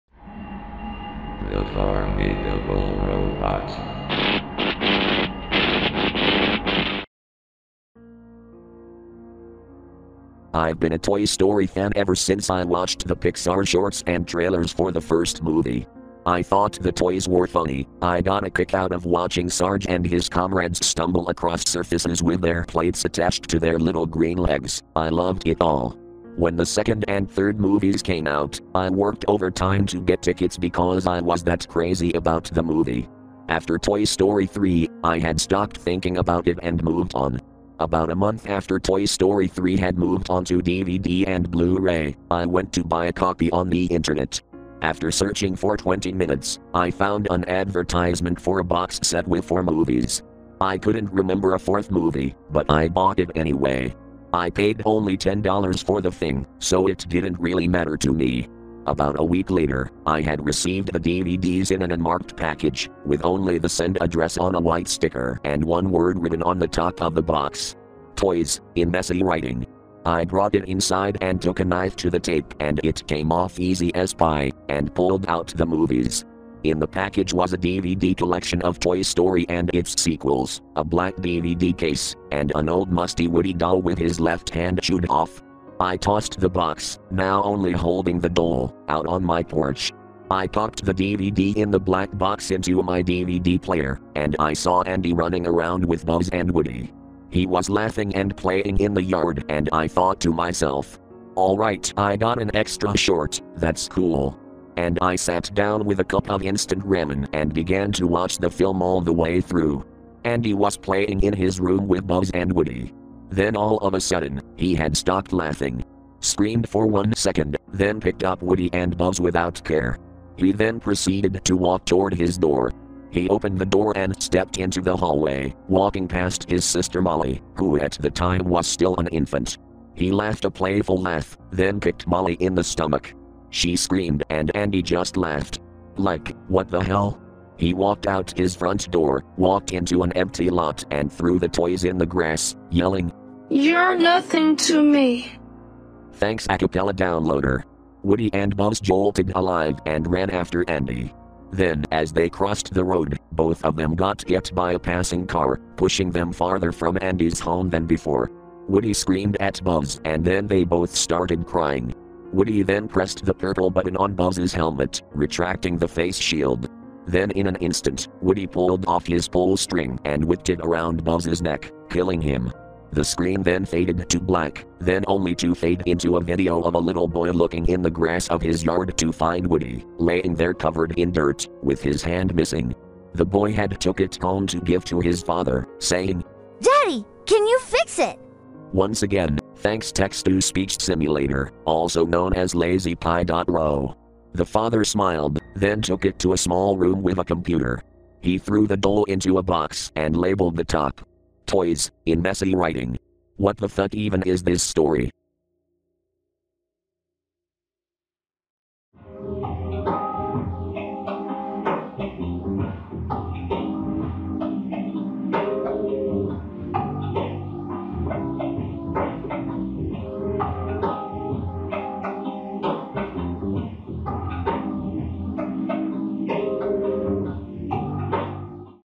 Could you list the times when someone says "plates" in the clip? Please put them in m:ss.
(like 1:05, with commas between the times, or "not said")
0:22.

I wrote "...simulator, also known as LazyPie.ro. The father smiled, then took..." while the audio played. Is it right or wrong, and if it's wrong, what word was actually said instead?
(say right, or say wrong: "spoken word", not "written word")
right.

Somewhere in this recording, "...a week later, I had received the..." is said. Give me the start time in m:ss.
0:59.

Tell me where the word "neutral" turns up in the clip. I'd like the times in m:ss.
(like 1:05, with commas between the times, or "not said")
not said.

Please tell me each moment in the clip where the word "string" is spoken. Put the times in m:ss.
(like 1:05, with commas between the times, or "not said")
2:49.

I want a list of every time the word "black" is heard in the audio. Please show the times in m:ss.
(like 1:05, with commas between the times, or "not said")
1:20, 1:31, 2:54.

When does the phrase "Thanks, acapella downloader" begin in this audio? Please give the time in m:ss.
2:26.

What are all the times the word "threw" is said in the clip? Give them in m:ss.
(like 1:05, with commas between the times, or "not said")
2:21, 3:18.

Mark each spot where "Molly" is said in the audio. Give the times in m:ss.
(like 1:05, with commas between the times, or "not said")
2:07, 2:12.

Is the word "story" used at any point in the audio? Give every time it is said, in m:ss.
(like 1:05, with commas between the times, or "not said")
0:11, 0:34, 0:39, 1:19, 3:24.